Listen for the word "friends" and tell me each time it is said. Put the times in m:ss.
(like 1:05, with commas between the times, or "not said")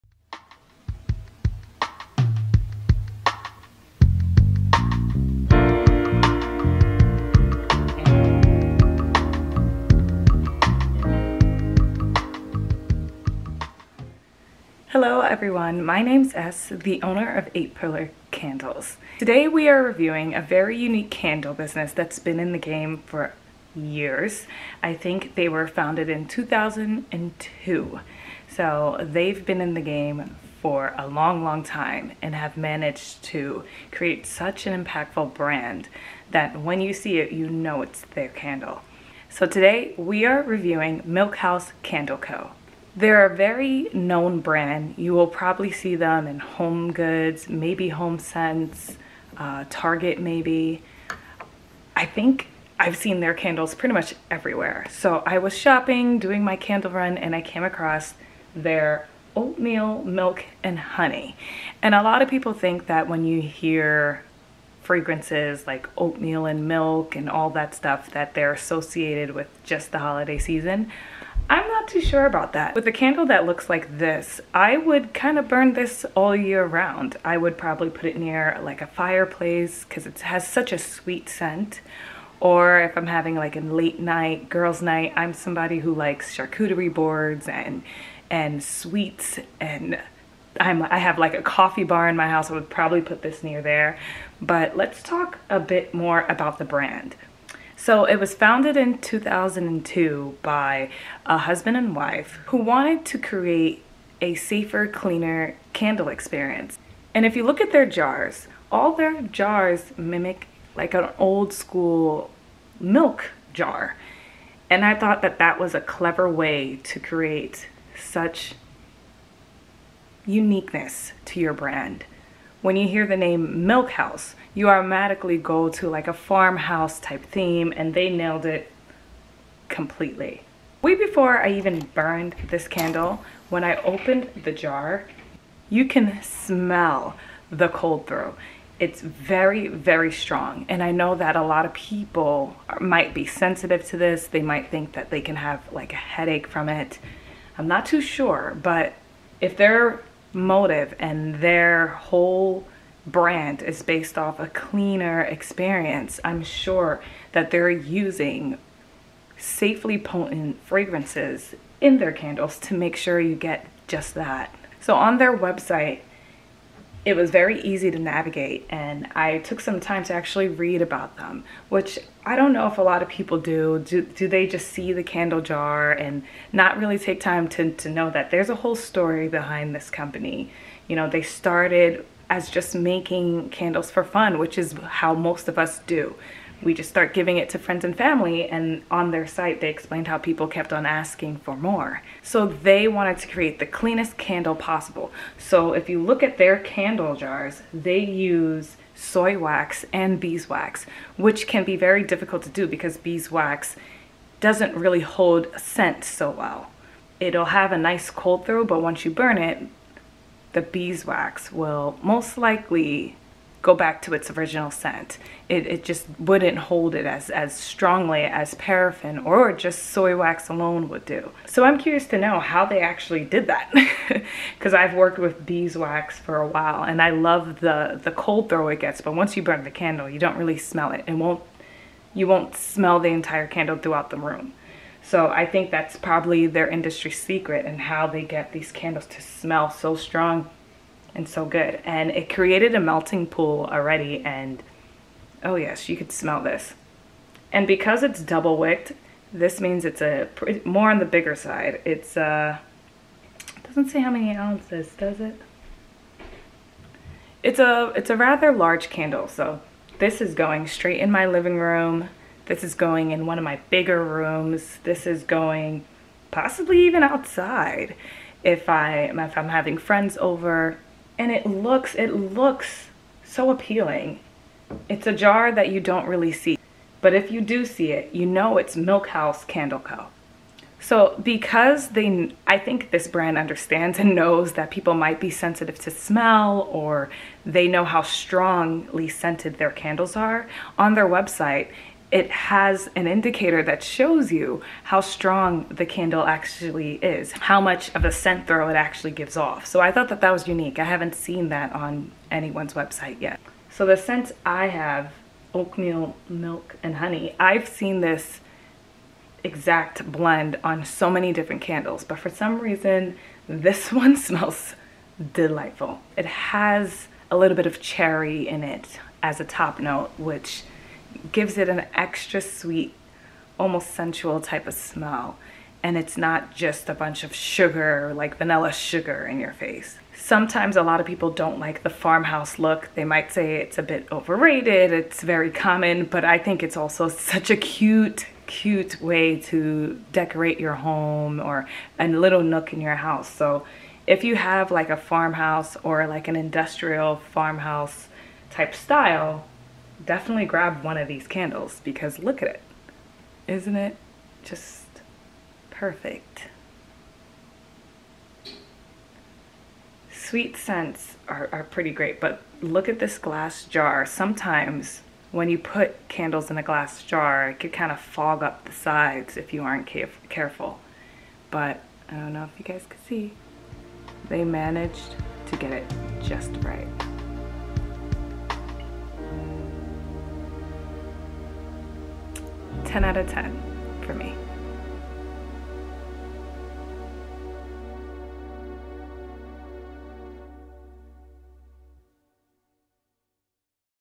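3:07, 4:29.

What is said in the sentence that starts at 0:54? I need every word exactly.
So I was shopping, doing my candle run, and I came across their oatmeal, milk, and honey.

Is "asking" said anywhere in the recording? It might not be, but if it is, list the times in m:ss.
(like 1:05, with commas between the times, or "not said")
3:10.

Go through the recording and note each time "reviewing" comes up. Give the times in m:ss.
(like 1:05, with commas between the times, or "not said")
0:19, 0:40.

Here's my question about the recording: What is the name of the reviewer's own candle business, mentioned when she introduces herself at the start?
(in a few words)
8 Pillar Candles.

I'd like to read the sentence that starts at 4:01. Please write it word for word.
And it created a melting pool already and oh yes, you could smell this.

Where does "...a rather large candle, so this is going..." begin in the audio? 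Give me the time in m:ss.
4:18.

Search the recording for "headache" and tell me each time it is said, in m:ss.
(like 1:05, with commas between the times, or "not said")
2:25.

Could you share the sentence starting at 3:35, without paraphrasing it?
It, it just wouldn't hold it as, as strongly as paraffin or just soy wax alone would do.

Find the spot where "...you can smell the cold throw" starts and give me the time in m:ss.
2:15.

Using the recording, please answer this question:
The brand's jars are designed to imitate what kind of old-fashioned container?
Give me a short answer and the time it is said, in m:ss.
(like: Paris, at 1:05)
Milk jar, at 1:51.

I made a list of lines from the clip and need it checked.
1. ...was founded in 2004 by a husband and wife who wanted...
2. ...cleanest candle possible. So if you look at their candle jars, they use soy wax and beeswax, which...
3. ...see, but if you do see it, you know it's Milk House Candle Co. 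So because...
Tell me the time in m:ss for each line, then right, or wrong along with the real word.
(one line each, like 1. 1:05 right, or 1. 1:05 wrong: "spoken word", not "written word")
1. 1:38 wrong: "2002", not "2004"
2. 3:13 right
3. 4:36 right.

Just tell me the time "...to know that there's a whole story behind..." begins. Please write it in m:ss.
2:57.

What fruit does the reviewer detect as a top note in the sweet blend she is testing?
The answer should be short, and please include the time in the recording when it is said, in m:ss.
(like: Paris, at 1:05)
Cherry, at 5:17.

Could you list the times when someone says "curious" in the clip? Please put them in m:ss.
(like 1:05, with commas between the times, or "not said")
3:41.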